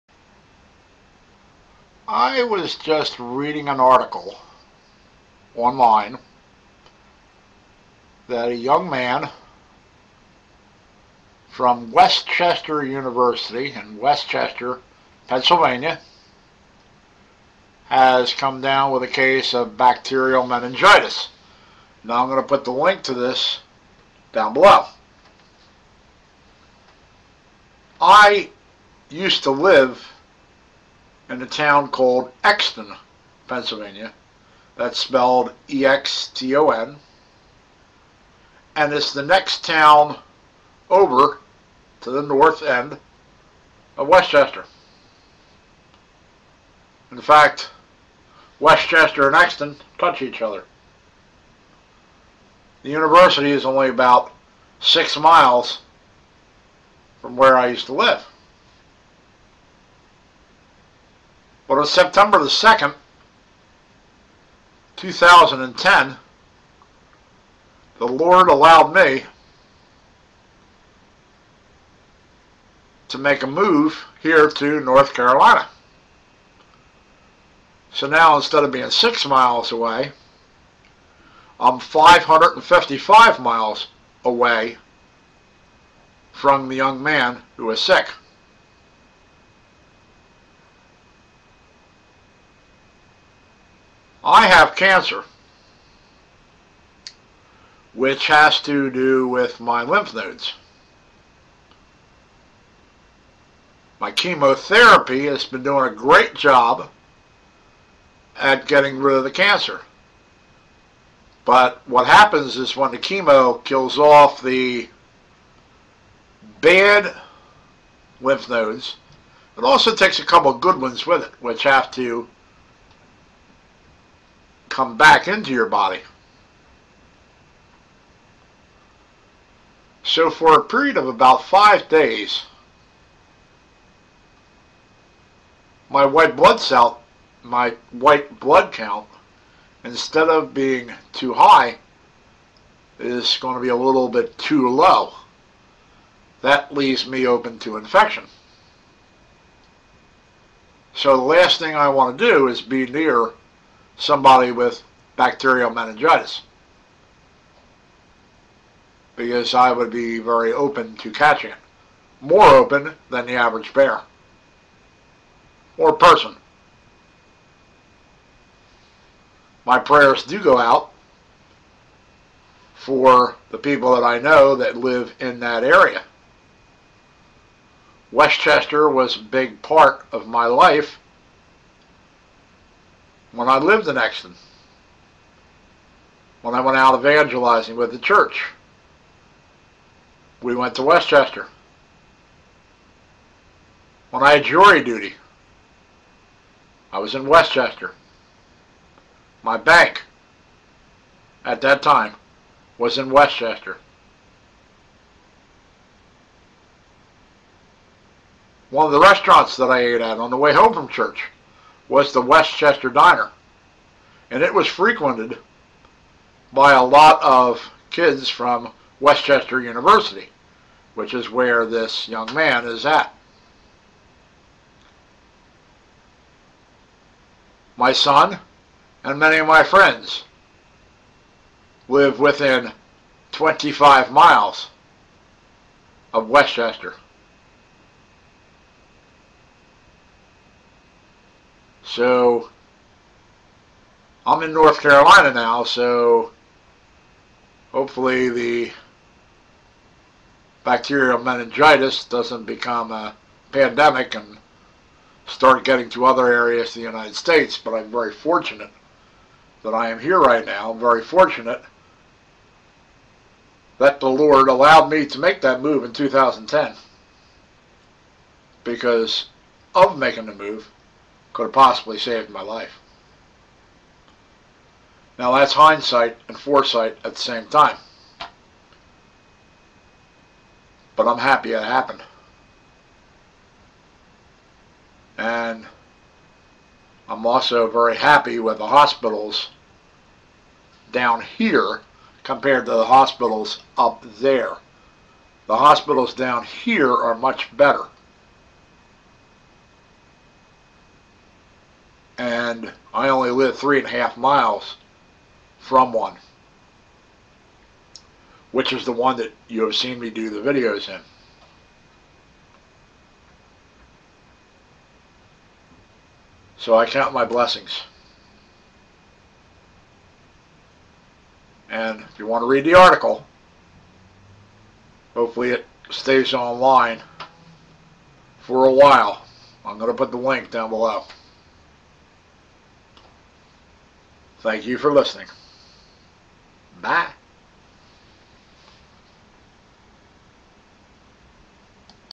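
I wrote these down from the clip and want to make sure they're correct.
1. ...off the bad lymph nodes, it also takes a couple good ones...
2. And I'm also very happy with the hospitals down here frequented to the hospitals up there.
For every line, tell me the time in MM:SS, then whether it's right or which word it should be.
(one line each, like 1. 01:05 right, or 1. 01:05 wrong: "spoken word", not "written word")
1. 01:53 right
2. 04:45 wrong: "compared", not "frequented".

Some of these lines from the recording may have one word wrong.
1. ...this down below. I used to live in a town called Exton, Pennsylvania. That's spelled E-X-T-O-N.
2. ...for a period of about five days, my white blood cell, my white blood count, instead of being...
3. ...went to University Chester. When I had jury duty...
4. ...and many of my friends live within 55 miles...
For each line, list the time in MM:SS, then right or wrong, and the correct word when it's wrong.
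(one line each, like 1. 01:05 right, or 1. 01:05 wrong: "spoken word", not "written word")
1. 00:23 right
2. 02:10 right
3. 03:10 wrong: "West", not "University"
4. 03:49 wrong: "25", not "55".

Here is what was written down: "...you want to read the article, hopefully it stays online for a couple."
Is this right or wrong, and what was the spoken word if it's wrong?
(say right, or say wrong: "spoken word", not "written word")
wrong: "while", not "couple".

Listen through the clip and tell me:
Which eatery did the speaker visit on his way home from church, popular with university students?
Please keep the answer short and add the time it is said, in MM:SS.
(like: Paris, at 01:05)
West Chester Diner, at 03:32.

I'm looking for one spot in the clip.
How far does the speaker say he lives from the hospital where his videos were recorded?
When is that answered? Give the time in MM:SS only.
05:03.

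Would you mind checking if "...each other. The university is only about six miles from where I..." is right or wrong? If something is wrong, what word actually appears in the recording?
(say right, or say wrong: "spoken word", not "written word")
right.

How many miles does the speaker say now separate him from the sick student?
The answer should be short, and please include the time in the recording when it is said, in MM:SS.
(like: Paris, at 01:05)
555, at 01:21.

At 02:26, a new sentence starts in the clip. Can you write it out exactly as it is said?
That leaves me open to infection.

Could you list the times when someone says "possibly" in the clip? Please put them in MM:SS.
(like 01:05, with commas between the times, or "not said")
04:31.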